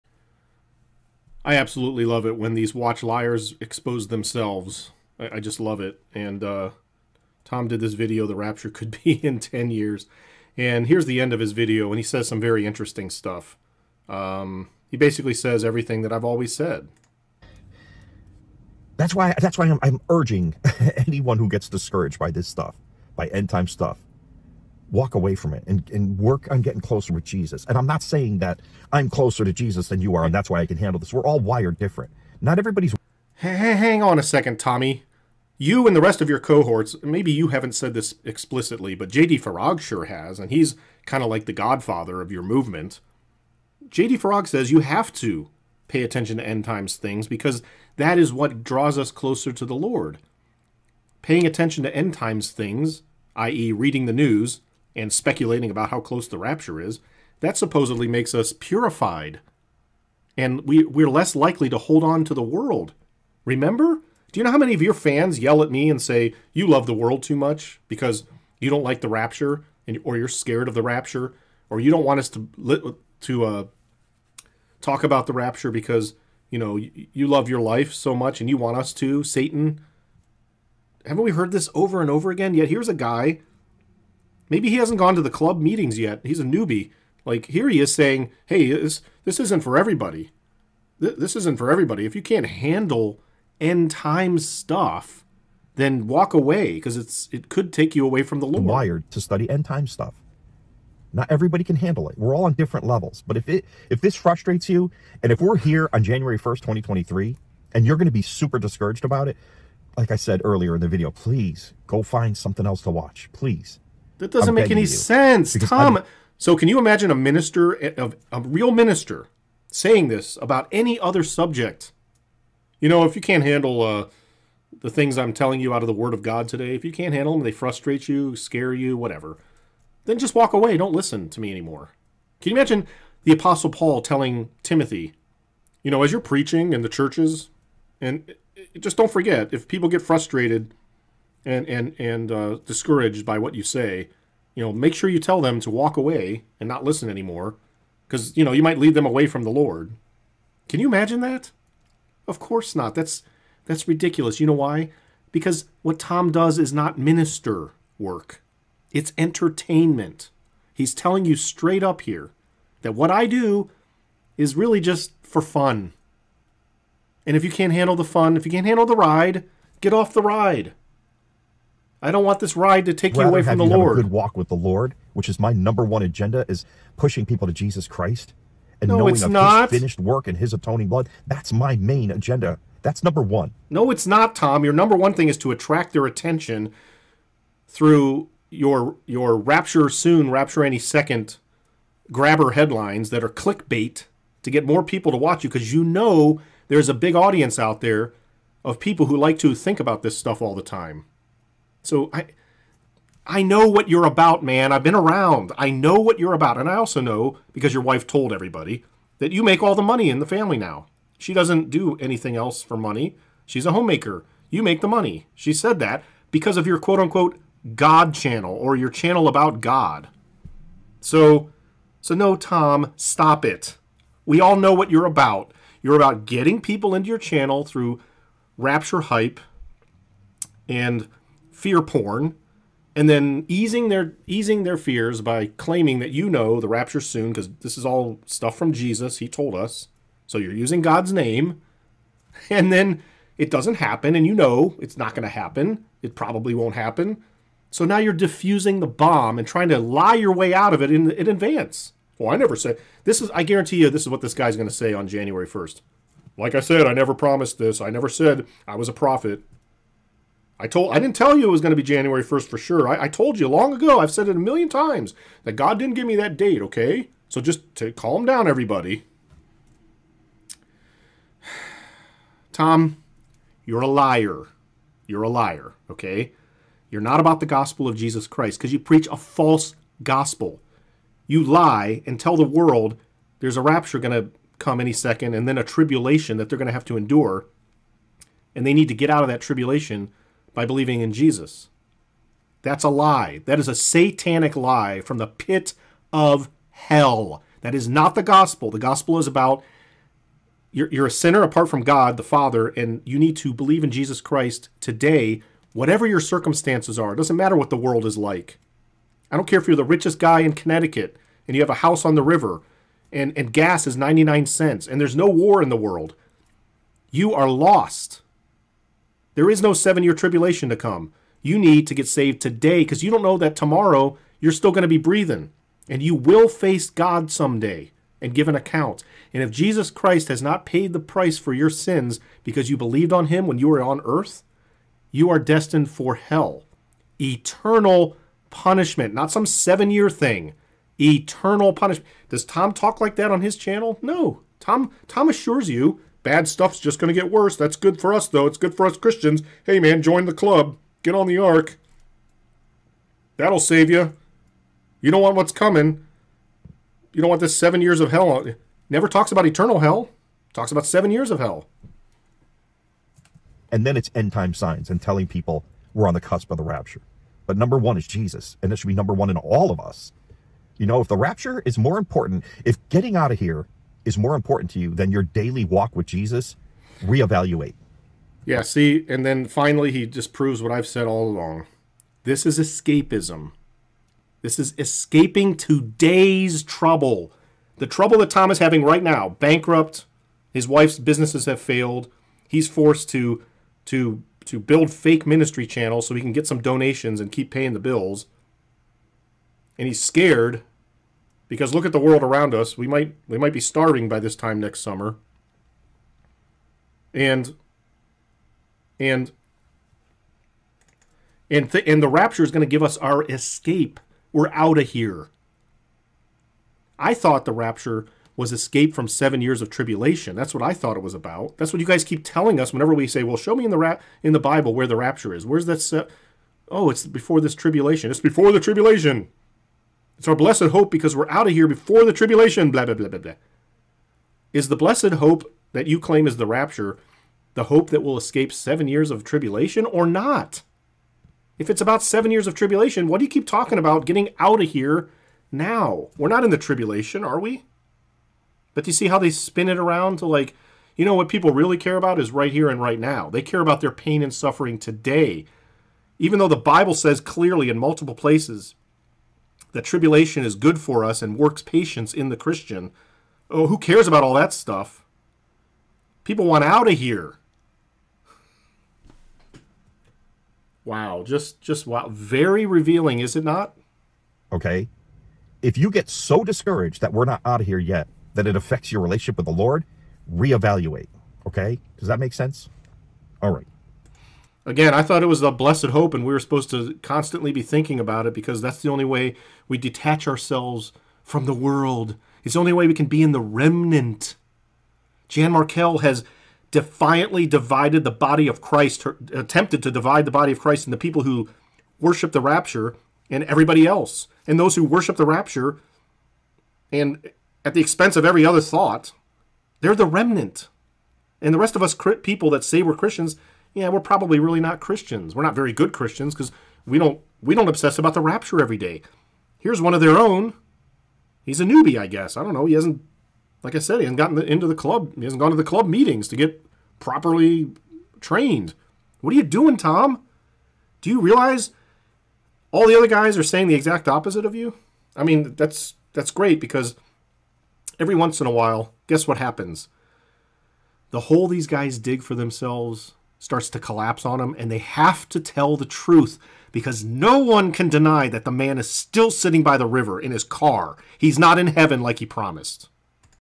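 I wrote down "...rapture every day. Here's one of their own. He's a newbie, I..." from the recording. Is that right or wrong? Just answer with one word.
right.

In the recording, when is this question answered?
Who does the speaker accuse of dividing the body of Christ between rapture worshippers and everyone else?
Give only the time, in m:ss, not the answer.
8:15.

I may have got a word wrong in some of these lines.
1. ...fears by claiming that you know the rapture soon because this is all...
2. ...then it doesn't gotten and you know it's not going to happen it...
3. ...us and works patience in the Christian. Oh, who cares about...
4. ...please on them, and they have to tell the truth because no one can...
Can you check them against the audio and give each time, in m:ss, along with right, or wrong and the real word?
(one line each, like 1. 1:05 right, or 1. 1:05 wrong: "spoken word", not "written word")
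1. 3:54 right
2. 4:02 wrong: "happen", not "gotten"
3. 7:41 right
4. 9:03 wrong: "collapse", not "please".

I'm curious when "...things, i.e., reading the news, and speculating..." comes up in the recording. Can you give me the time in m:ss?
0:52.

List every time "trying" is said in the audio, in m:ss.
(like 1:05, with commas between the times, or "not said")
4:09.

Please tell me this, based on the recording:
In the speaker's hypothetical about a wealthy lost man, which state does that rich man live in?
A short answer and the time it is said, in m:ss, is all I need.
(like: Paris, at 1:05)
Connecticut, at 5:10.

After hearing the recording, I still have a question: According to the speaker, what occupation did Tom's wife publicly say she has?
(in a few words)
Homemaker.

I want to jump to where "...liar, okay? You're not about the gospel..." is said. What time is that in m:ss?
4:35.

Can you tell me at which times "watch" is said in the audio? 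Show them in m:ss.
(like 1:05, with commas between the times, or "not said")
0:02, 1:52, 3:15.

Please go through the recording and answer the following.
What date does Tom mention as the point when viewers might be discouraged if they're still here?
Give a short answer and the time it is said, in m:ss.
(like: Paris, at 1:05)
January 1, 2023, at 1:46.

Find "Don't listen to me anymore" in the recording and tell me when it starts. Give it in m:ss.
2:10.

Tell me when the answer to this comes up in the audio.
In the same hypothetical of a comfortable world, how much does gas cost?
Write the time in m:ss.
5:13.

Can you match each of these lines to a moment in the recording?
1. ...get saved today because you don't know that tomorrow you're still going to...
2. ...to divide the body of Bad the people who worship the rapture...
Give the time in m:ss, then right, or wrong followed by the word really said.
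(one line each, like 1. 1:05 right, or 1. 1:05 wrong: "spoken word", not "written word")
1. 5:21 right
2. 8:19 wrong: "Christ", not "Bad".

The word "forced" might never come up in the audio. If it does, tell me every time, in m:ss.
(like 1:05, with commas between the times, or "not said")
6:32.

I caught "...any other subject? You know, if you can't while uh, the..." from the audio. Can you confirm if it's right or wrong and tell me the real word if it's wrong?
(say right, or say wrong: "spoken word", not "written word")
wrong: "handle", not "while".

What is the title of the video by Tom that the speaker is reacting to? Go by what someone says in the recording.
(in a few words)
The Rapture Could Be in 10 Years.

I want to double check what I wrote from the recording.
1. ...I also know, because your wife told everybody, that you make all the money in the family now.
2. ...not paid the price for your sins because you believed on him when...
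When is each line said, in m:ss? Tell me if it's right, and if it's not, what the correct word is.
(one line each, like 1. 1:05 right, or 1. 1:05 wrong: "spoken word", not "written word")
1. 3:26 right
2. 5:30 right.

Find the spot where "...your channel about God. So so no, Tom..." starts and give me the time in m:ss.
3:38.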